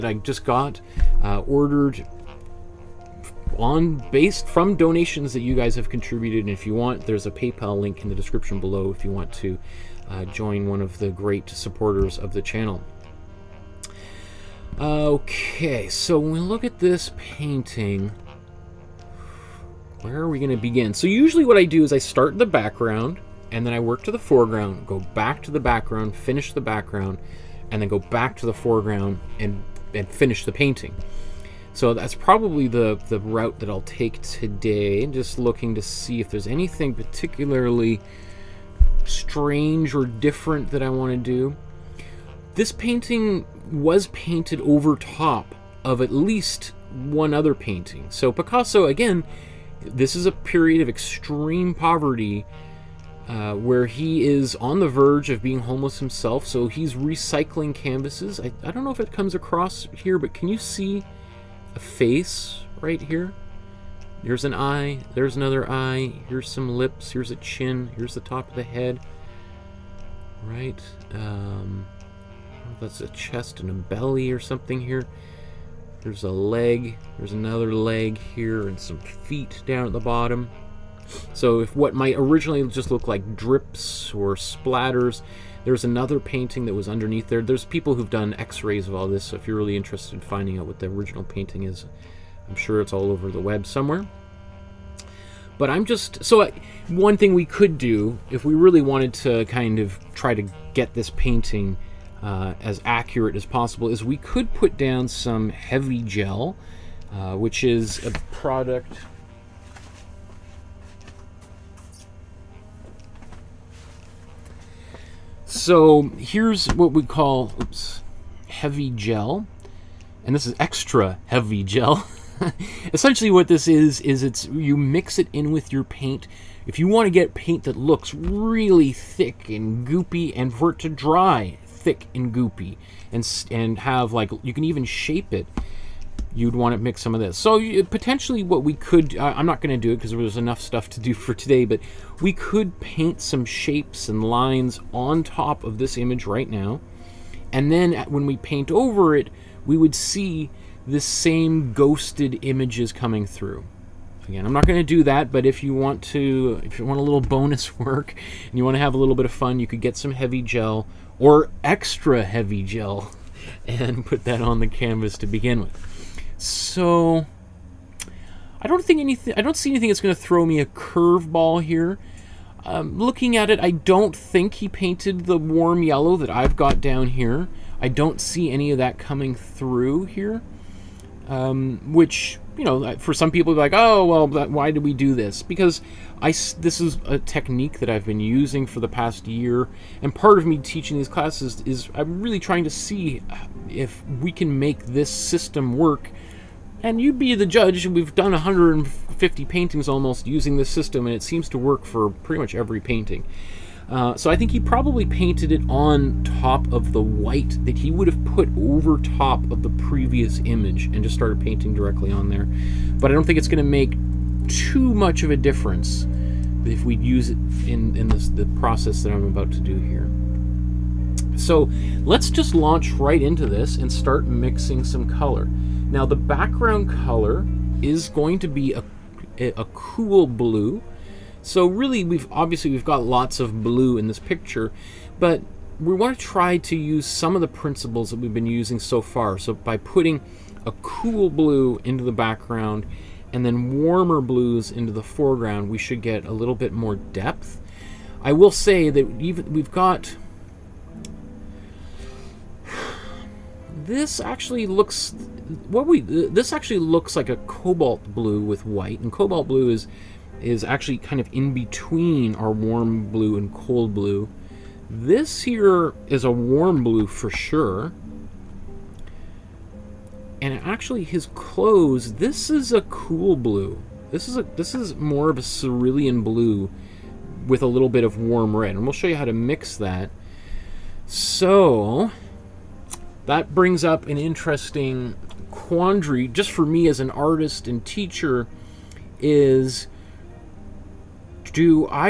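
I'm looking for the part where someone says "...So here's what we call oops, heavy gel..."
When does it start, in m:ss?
1:55.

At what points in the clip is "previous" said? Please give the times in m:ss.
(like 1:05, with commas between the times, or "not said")
3:29.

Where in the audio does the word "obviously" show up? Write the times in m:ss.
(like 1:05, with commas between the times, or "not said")
3:52.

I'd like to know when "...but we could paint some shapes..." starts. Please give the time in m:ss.
2:21.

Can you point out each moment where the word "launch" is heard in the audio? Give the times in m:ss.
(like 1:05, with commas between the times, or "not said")
3:42.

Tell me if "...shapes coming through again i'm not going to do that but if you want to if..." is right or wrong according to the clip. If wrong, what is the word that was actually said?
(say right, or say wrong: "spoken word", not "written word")
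wrong: "images", not "shapes".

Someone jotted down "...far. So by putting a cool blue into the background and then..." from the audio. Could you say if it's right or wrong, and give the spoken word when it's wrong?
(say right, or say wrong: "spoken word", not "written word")
right.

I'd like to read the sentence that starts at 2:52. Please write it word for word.
Um, looking at it, I don't think he painted the warm yellow that I've got down here.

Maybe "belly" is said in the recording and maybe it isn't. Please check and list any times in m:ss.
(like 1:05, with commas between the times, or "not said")
1:13.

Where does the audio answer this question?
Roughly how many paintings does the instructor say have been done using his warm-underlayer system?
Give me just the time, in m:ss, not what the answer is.
3:18.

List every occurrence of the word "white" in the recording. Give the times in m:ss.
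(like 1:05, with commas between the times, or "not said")
3:27, 4:18.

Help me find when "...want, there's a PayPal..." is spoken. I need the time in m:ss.
0:06.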